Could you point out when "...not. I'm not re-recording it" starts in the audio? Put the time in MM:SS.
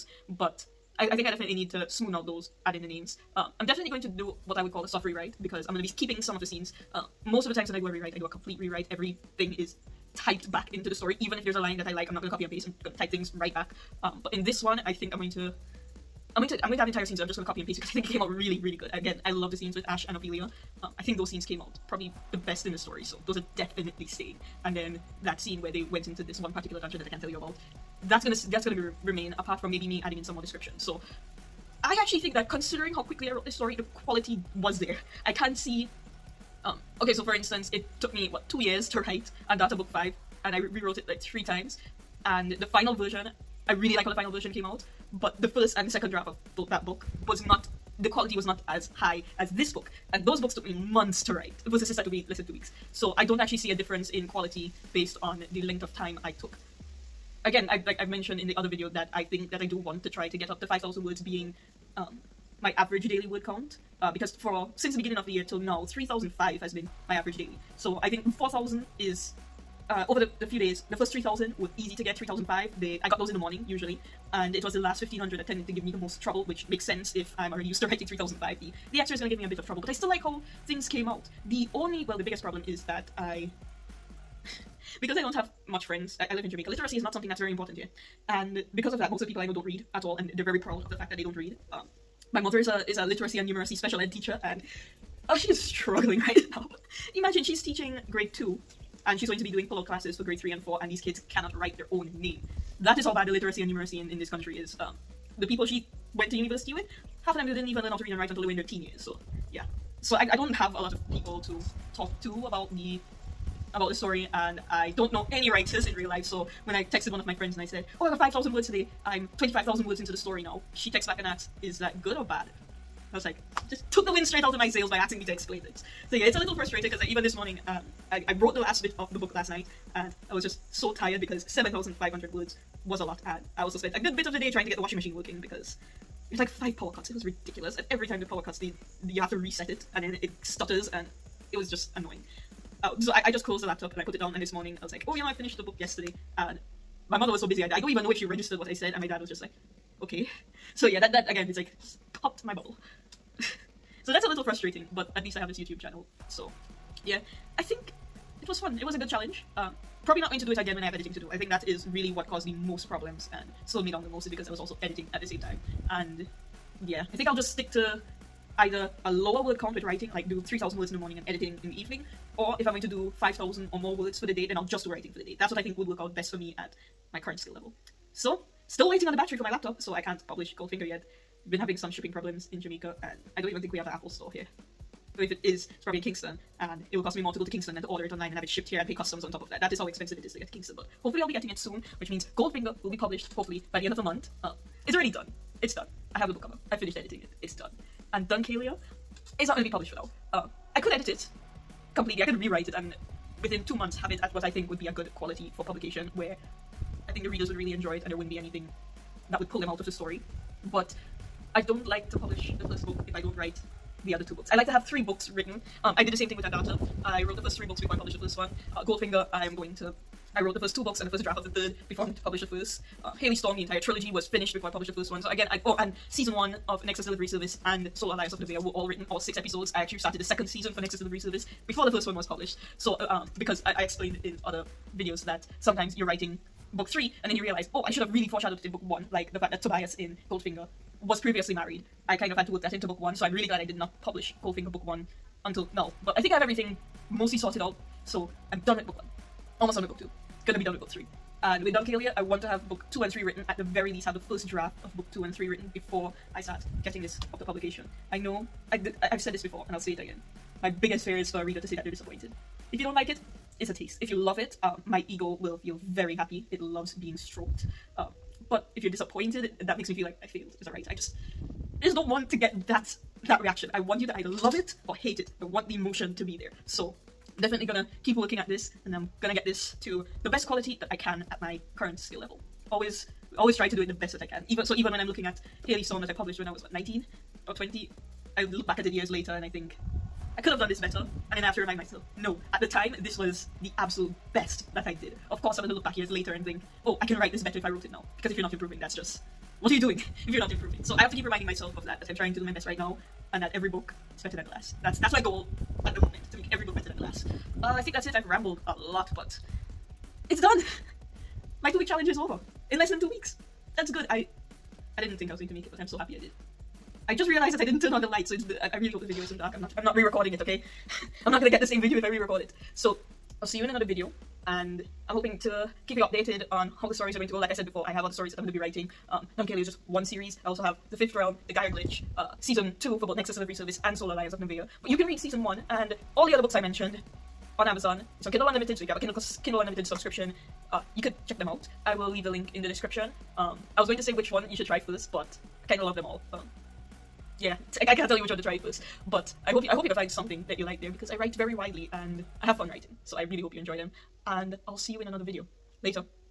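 05:19.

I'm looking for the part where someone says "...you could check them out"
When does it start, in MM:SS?
05:40.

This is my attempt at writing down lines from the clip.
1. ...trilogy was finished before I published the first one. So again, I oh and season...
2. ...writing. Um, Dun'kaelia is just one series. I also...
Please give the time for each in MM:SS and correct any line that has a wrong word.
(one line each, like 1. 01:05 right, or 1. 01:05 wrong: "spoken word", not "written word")
1. 03:43 right
2. 05:28 right.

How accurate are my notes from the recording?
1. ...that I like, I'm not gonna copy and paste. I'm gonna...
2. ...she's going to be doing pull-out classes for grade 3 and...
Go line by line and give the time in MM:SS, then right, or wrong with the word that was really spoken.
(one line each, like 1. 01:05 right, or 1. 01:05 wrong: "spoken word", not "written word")
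1. 00:11 right
2. 01:39 right.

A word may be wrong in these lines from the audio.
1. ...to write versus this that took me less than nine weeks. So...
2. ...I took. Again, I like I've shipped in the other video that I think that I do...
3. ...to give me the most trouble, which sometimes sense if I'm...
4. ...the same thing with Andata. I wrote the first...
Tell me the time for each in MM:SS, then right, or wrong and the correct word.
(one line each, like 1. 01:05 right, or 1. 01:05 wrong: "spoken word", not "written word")
1. 00:51 wrong: "two", not "nine"
2. 00:56 wrong: "mentioned", not "shipped"
3. 01:15 wrong: "makes", not "sometimes"
4. 03:36 right.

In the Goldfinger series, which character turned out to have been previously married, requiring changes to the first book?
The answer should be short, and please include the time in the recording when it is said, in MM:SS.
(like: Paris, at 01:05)
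Tobias, at 03:59.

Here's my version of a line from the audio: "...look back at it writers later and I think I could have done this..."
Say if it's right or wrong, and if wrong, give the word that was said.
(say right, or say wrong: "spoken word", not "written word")
wrong: "years", not "writers".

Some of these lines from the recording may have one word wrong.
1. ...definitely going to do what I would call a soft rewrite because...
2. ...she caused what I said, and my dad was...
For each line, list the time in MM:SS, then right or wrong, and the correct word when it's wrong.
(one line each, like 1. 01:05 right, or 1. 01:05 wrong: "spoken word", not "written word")
1. 00:03 right
2. 02:28 wrong: "registered", not "caused".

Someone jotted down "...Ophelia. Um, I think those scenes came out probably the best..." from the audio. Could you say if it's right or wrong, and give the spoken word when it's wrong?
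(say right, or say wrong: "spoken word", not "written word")
right.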